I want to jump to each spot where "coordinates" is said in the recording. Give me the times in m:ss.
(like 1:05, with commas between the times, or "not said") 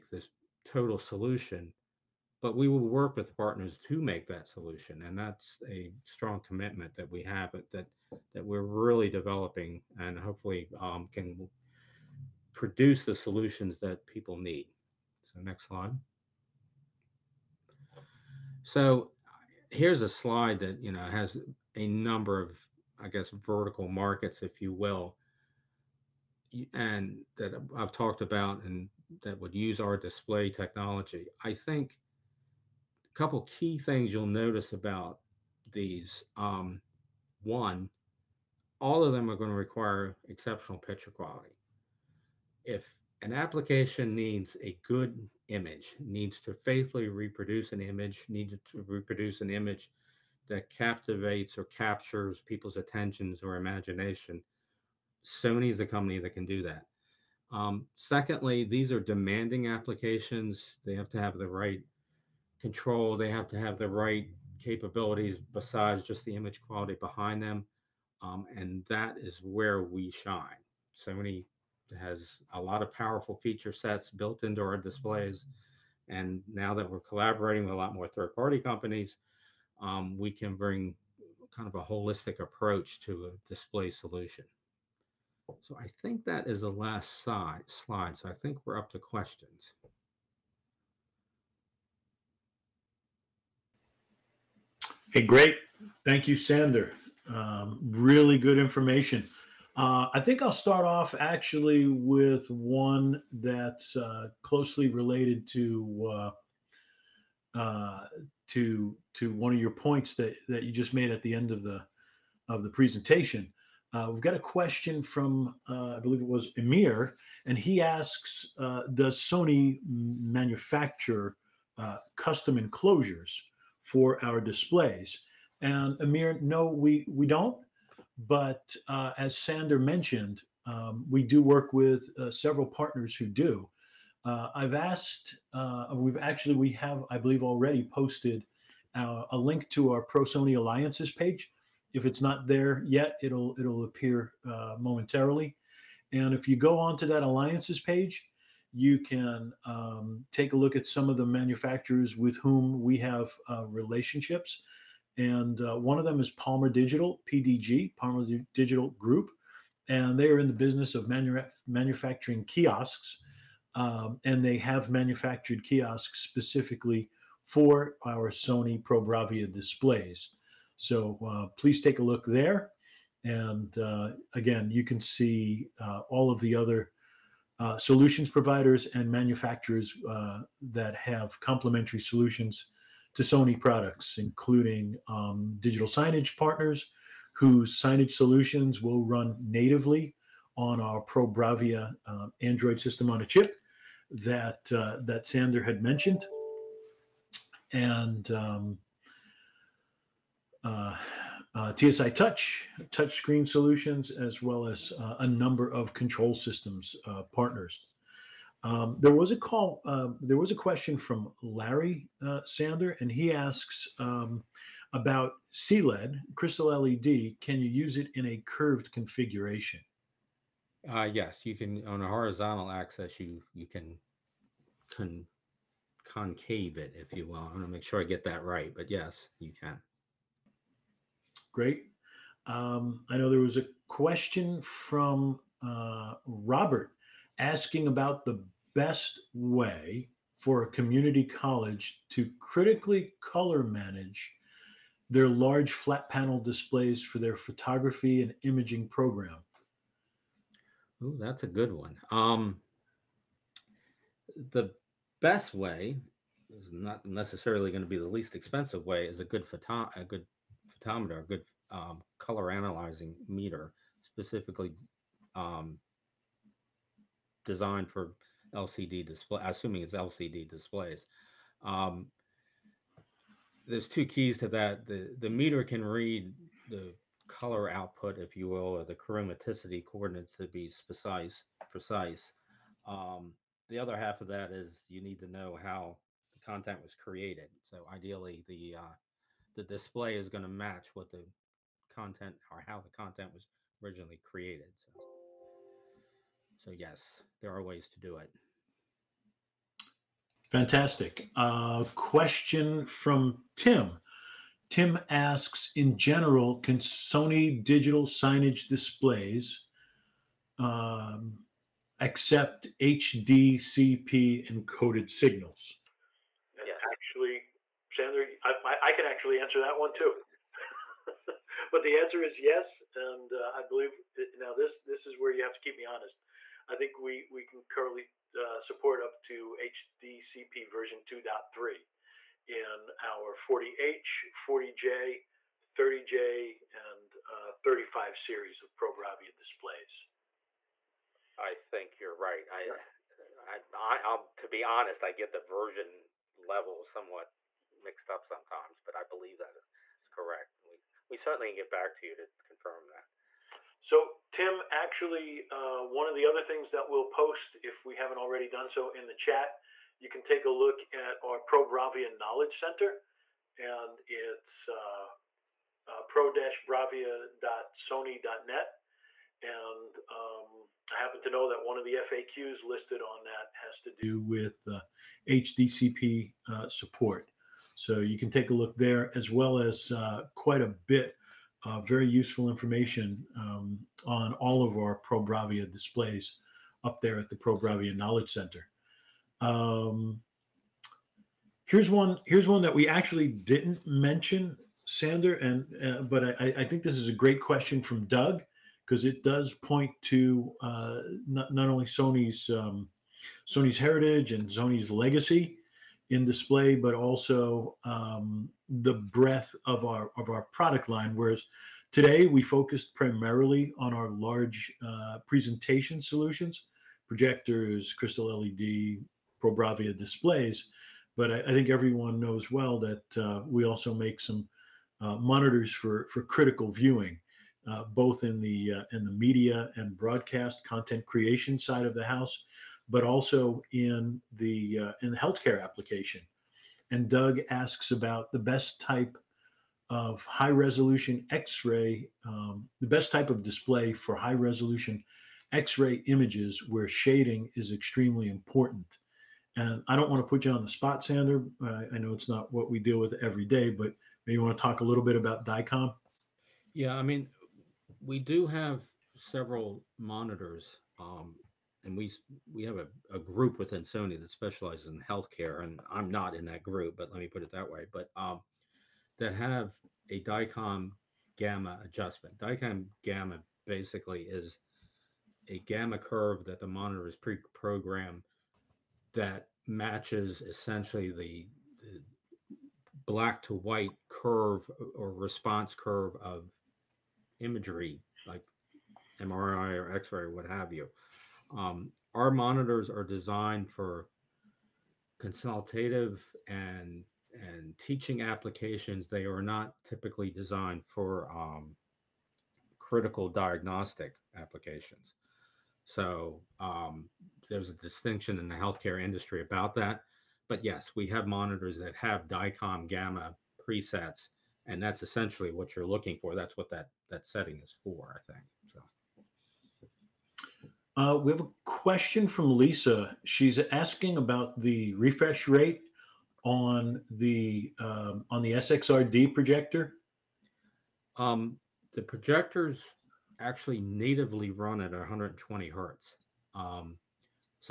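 4:39.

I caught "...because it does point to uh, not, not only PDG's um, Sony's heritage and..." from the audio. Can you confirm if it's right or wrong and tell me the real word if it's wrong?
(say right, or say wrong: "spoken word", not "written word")
wrong: "Sony", not "PDG".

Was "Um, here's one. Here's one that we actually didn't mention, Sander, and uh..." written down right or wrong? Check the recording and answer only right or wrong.
right.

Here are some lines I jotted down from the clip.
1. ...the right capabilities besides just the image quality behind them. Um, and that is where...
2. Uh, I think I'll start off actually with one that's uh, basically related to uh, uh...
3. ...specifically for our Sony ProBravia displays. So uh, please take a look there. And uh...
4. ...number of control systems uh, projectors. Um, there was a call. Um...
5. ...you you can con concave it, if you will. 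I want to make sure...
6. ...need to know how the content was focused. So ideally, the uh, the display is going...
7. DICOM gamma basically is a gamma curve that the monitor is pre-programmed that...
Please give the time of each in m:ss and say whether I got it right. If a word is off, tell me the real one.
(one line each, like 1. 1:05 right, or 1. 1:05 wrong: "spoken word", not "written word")
1. 1:03 right
2. 1:39 wrong: "closely", not "basically"
3. 2:46 right
4. 3:25 wrong: "partners", not "projectors"
5. 3:43 right
6. 4:45 wrong: "created", not "focused"
7. 7:52 right.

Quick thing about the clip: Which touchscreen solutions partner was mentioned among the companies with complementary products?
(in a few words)
TSI Touch.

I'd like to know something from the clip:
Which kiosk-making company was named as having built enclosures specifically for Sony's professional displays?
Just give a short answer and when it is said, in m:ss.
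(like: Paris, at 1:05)
Palmer Digital Group, at 2:37.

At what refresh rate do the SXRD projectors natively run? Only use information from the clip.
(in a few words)
120 hertz.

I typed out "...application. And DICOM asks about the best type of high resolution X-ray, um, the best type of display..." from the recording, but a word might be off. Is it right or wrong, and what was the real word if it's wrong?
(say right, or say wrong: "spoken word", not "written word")
wrong: "Doug", not "DICOM".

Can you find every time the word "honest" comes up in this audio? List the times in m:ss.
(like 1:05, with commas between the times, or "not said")
5:25, 5:44.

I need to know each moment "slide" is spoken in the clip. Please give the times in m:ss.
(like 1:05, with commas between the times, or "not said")
0:15, 0:20, 1:27.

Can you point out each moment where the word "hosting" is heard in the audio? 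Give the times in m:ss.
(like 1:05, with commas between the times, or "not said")
not said.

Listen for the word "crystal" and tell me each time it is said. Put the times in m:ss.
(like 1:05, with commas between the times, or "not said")
3:36, 6:57.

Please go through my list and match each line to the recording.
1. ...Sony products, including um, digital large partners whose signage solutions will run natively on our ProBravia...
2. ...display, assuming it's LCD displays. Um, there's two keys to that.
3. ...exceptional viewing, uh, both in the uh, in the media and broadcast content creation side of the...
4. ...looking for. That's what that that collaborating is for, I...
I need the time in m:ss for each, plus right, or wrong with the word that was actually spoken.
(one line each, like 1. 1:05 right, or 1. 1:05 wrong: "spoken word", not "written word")
1. 3:03 wrong: "signage", not "large"
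2. 4:29 right
3. 7:06 wrong: "critical", not "exceptional"
4. 8:35 wrong: "setting", not "collaborating".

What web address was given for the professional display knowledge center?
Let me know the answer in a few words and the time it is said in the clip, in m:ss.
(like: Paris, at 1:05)
pro-bravia.sony.net, at 6:06.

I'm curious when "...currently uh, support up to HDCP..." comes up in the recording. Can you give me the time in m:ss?
5:27.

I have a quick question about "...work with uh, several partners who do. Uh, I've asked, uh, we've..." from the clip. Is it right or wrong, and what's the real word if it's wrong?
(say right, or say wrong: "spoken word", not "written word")
right.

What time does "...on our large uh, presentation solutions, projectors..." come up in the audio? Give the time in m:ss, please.
6:53.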